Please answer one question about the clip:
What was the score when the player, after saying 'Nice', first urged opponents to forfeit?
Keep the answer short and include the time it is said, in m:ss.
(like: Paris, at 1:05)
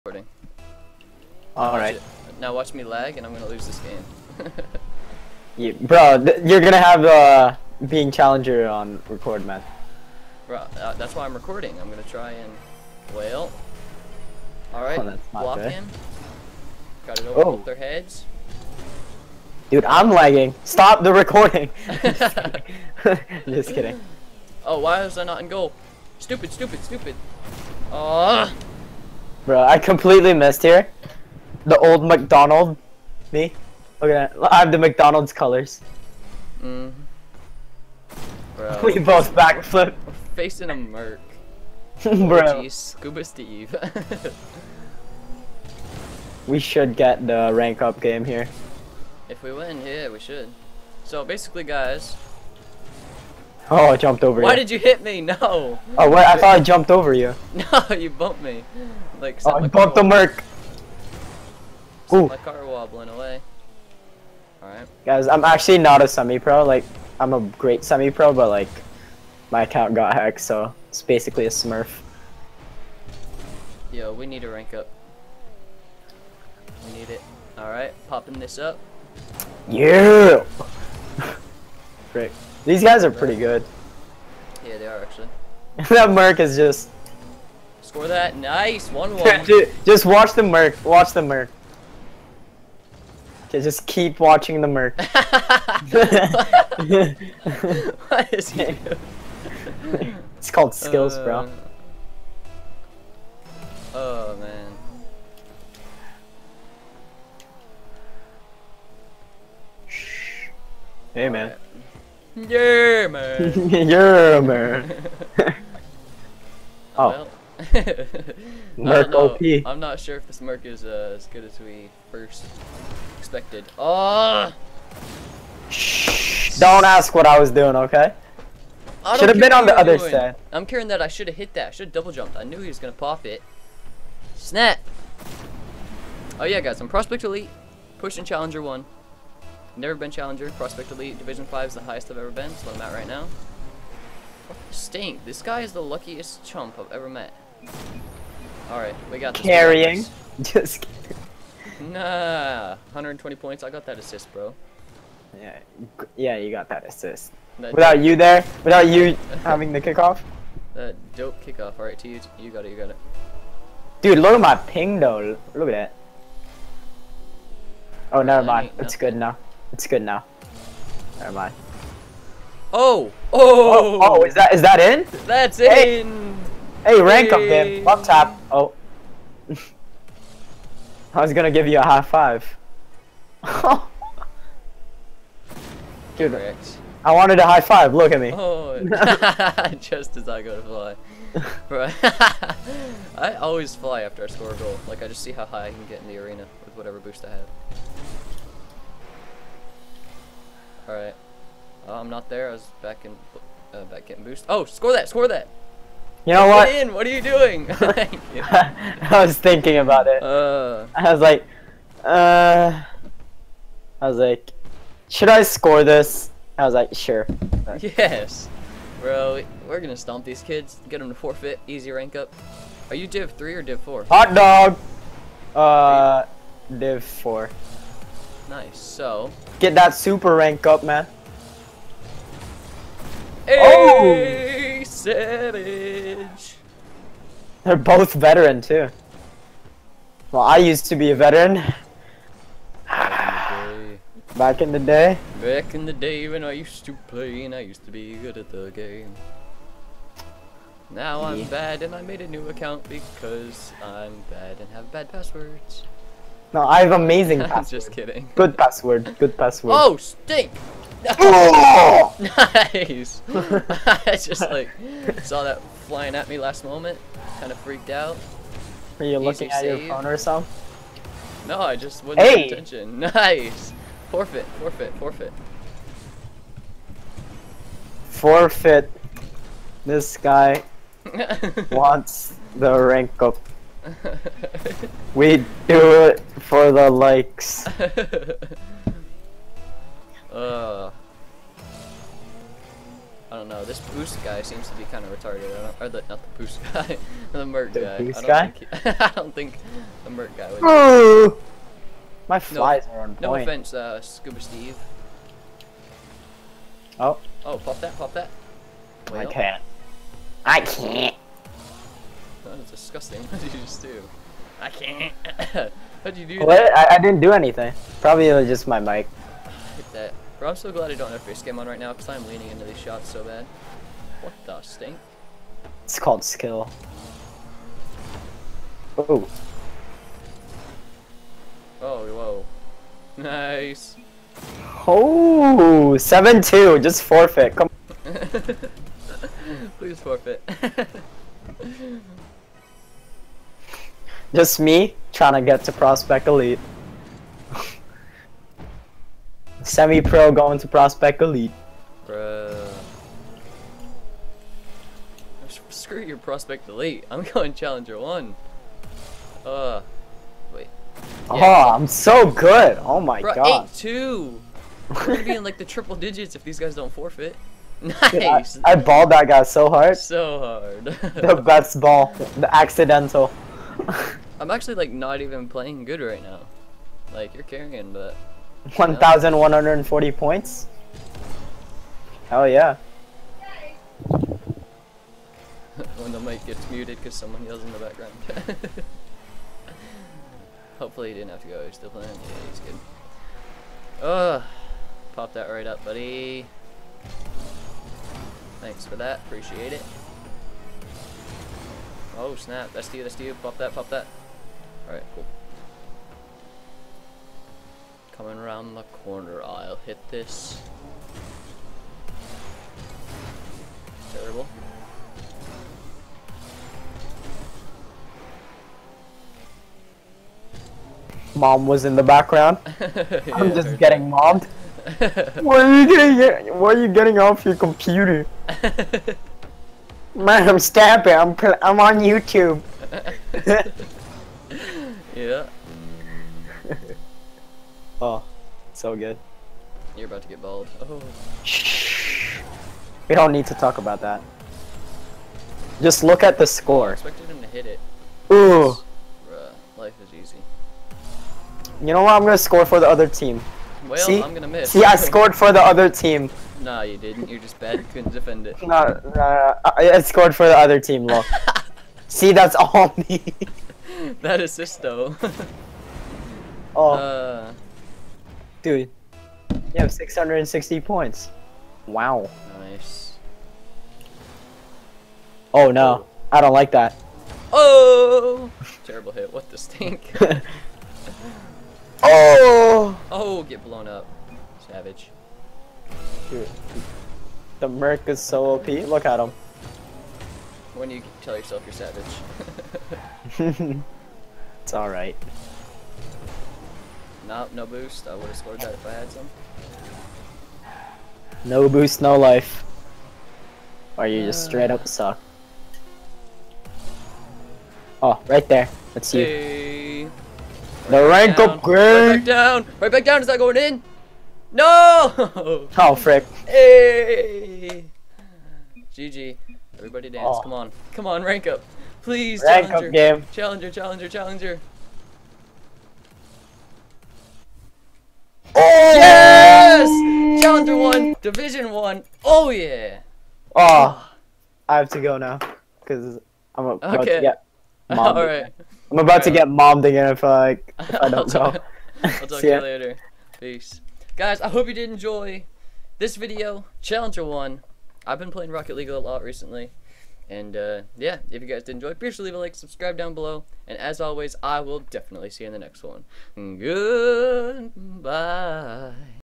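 7-2, at 5:35.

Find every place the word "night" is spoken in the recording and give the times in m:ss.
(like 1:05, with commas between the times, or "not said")
not said.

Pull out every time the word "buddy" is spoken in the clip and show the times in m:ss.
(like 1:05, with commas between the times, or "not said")
6:35.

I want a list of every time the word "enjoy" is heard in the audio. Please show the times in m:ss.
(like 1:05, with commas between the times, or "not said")
9:04, 9:11.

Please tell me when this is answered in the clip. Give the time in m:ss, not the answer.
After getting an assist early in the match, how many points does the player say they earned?
2:32.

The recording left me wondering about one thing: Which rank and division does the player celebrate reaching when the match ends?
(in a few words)
Challenger 1, Division 1.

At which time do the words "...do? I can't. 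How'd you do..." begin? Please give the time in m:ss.
5:13.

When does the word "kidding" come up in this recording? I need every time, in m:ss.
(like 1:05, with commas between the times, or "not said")
0:23, 2:30, 4:17.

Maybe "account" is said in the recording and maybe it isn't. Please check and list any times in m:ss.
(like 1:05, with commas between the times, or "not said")
1:09, 4:12.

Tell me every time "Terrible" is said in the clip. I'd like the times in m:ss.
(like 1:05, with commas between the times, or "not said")
6:54, 7:58.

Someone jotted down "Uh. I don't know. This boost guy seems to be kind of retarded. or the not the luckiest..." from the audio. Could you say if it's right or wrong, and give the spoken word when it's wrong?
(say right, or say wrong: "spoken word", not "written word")
wrong: "boost", not "luckiest".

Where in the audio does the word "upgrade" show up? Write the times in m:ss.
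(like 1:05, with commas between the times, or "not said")
8:31.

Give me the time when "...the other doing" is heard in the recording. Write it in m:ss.
2:09.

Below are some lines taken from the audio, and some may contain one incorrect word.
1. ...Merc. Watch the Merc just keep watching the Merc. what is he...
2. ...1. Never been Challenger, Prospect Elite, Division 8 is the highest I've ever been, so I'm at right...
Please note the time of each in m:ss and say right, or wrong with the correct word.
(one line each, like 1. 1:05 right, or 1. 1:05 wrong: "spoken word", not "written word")
1. 1:30 right
2. 2:18 wrong: "5", not "8".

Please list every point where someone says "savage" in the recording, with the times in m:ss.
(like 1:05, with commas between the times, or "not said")
8:04, 8:13.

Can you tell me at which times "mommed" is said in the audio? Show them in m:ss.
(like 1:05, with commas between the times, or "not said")
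8:59.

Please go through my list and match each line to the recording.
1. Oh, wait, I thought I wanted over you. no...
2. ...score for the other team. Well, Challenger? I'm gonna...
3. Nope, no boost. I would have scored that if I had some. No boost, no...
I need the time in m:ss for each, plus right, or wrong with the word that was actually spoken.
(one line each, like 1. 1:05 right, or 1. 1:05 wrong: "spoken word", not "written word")
1. 0:55 wrong: "jumped", not "wanted"
2. 7:32 wrong: "See", not "Challenger"
3. 8:17 right.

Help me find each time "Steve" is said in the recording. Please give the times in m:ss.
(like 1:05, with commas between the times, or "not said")
0:43, 5:04.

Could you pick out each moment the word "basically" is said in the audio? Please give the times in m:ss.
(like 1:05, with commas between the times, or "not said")
0:51, 1:11.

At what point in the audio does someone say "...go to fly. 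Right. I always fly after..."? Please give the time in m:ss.
3:10.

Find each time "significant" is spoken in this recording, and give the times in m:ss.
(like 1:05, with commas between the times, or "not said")
not said.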